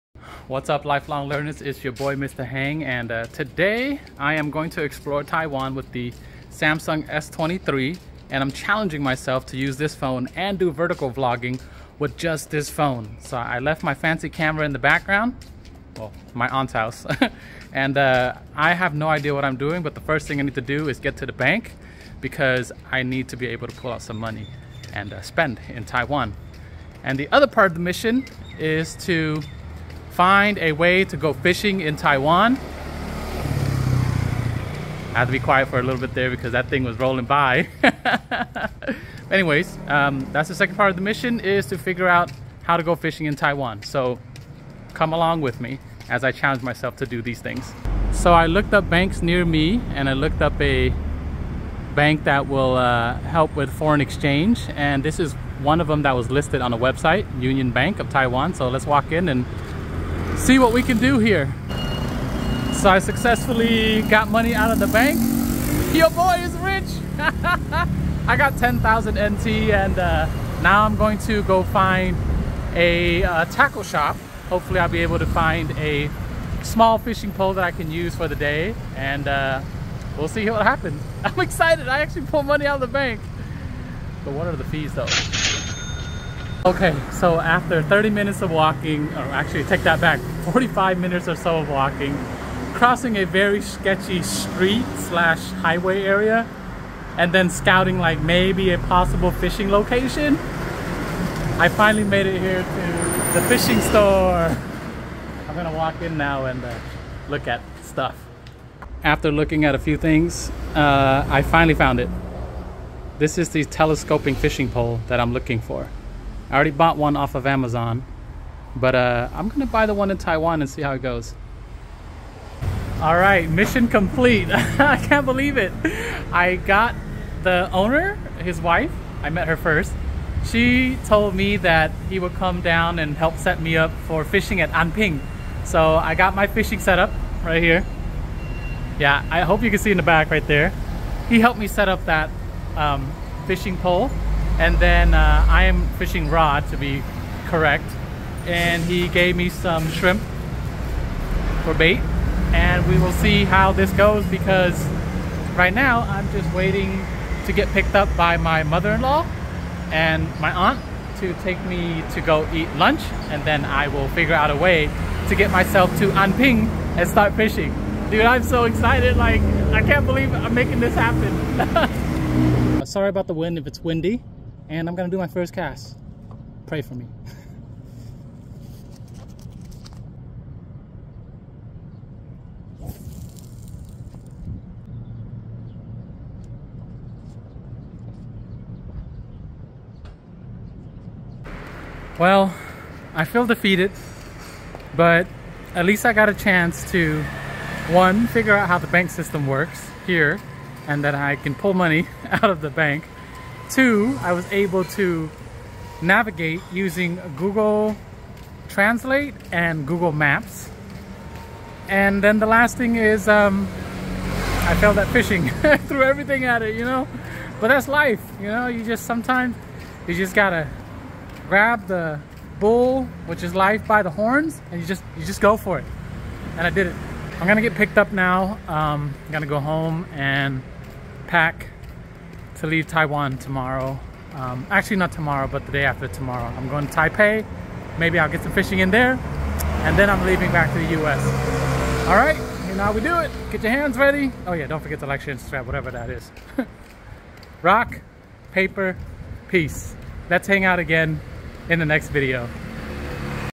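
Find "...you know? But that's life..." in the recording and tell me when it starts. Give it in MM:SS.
03:36.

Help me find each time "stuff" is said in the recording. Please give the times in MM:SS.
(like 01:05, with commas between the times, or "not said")
01:47.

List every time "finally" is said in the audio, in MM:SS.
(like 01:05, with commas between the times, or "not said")
01:41, 01:51.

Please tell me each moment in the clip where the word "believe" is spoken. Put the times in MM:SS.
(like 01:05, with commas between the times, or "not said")
02:05, 02:50.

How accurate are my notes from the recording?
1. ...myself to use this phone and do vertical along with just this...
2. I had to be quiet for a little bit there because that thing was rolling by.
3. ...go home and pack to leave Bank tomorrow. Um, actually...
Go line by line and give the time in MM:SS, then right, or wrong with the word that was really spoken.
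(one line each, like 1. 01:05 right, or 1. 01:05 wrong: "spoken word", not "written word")
1. 00:09 wrong: "vlogging", not "along"
2. 00:35 right
3. 03:49 wrong: "Taiwan", not "Bank".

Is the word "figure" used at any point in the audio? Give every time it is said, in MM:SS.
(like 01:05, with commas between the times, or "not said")
00:41, 02:44, 03:18.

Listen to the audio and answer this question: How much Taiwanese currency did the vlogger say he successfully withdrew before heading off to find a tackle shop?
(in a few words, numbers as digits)
10,000 NT.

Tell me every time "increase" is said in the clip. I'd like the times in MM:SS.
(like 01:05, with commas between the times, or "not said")
not said.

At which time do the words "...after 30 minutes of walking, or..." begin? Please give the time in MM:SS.
01:27.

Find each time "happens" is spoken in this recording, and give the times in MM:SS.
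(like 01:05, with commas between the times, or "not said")
01:20, 02:50.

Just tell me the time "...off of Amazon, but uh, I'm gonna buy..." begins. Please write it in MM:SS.
01:57.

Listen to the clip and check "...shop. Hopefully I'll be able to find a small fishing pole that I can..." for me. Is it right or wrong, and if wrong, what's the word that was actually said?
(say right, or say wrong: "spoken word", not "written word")
right.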